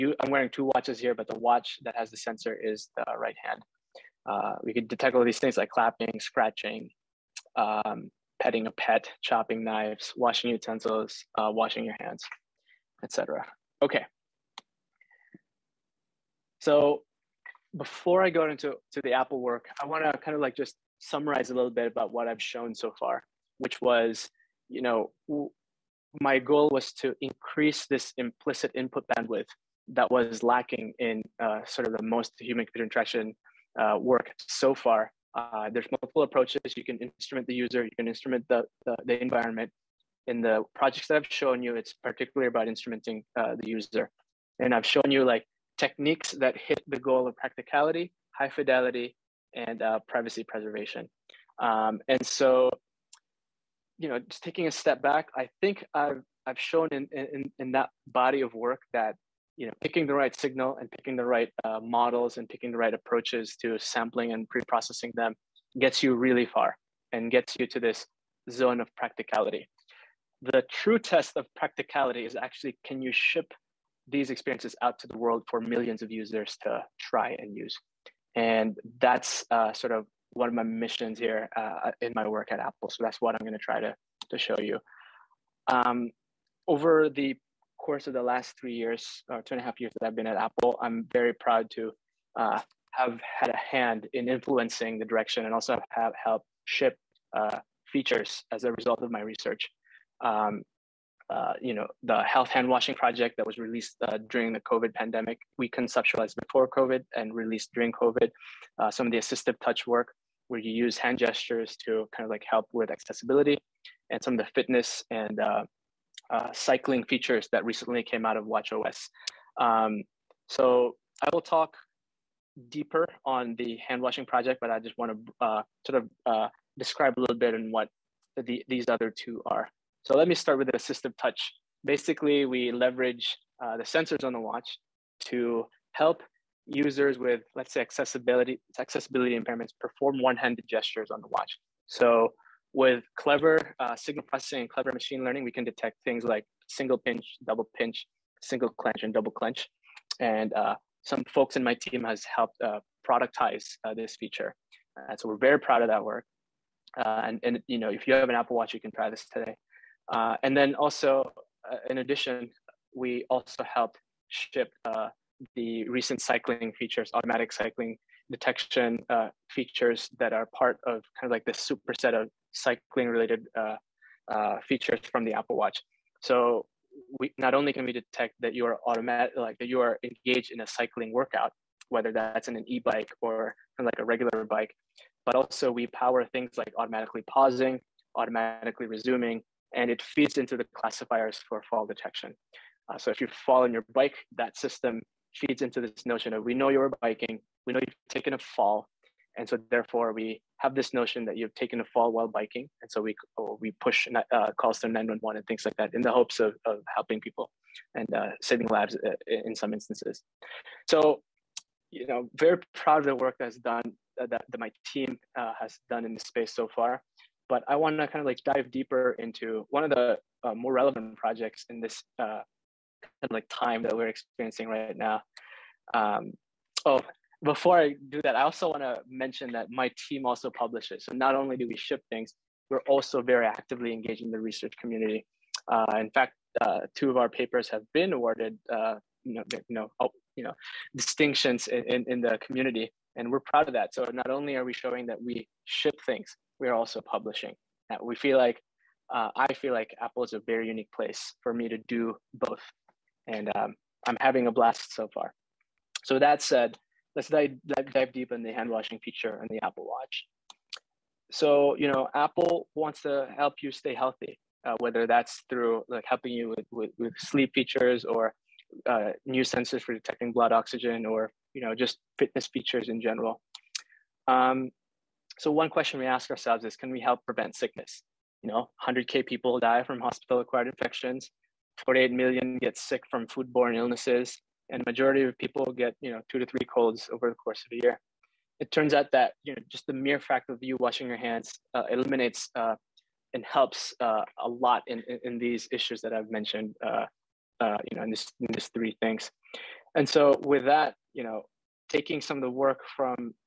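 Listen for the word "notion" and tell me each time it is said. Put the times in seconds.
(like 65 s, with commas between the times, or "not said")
196 s, 200 s.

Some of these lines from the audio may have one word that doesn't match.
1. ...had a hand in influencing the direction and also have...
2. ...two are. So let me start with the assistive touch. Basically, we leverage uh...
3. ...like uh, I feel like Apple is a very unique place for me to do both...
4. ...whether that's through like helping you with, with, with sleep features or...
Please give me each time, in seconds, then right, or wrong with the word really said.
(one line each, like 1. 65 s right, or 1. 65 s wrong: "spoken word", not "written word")
1. 93 s right
2. 129 s right
3. 248 s right
4. 264 s right.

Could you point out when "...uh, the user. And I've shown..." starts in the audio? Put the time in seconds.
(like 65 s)
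43 s.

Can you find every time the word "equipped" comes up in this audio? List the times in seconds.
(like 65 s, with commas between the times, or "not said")
not said.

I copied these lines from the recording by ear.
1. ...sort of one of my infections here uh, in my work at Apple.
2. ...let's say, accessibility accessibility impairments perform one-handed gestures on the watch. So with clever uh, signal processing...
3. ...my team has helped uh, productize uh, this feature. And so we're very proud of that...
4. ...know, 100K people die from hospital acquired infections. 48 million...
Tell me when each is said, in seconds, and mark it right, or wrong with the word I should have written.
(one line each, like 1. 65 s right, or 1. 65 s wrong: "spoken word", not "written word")
1. 79 s wrong: "missions", not "infections"
2. 137 s right
3. 151 s right
4. 278 s right.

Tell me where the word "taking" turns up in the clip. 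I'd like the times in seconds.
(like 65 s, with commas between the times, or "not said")
54 s, 301 s.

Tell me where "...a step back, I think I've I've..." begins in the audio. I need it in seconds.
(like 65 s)
54 s.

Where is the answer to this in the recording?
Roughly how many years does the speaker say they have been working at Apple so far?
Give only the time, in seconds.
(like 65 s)
89 s.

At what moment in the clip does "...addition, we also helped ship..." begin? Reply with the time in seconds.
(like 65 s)
161 s.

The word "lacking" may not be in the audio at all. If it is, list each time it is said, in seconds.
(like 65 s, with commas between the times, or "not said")
30 s.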